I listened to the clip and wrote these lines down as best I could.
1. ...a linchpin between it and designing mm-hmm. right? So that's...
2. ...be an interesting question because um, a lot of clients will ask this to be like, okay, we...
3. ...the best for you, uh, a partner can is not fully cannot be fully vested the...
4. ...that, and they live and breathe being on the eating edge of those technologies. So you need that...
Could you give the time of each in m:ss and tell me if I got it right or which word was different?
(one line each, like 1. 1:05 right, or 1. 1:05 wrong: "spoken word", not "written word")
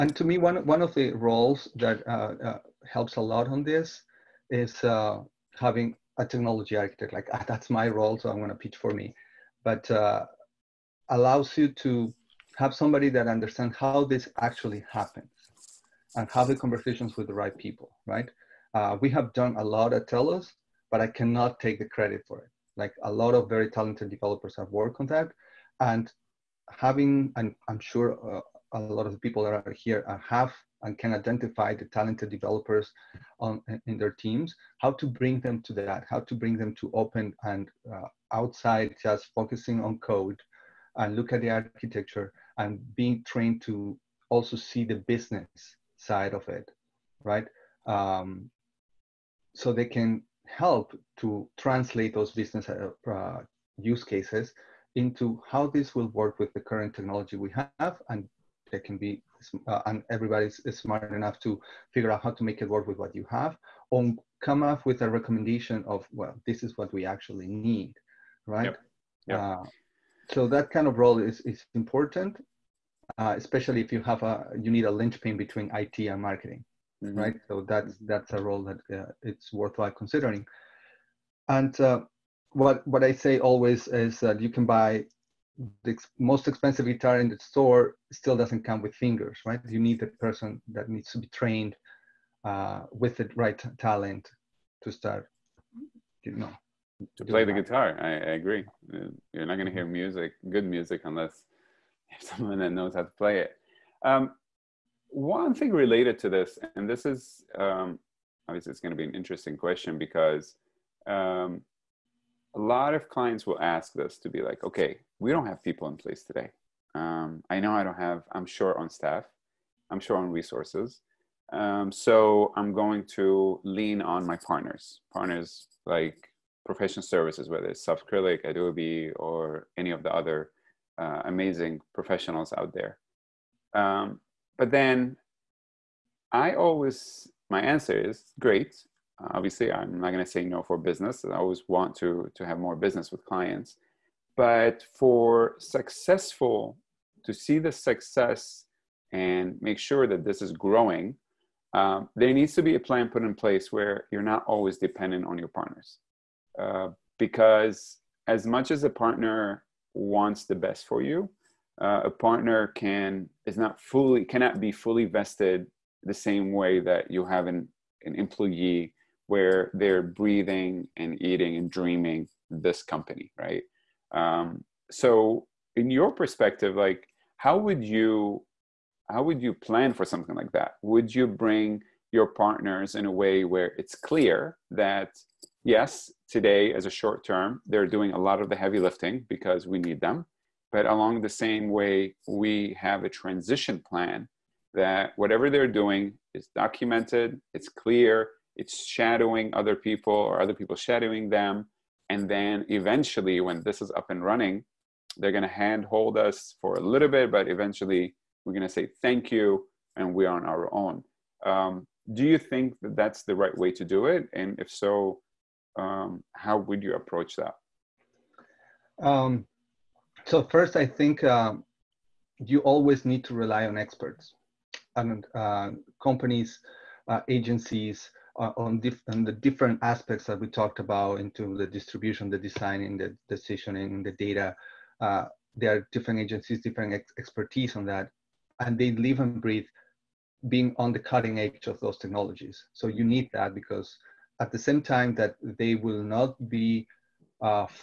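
1. 1:14 wrong: "marketing", not "designing"
2. 1:48 right
3. 2:40 right
4. 3:57 wrong: "cutting", not "eating".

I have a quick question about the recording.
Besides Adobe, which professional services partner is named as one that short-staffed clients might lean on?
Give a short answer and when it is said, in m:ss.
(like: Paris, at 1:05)
Softcrylic, at 2:07.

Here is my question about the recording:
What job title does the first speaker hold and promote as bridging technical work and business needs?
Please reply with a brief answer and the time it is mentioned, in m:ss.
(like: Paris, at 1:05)
Technology architect, at 0:06.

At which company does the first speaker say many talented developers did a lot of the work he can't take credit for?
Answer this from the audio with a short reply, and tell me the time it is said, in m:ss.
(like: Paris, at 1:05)
TELUS, at 0:20.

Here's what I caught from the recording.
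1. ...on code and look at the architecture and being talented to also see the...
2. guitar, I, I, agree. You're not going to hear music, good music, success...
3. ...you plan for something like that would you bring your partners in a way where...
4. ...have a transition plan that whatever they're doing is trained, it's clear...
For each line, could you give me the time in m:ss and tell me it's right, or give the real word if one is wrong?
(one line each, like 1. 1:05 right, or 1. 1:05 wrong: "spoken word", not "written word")
1. 0:39 wrong: "trained", not "talented"
2. 1:37 wrong: "unless", not "success"
3. 2:59 right
4. 3:12 wrong: "documented", not "trained".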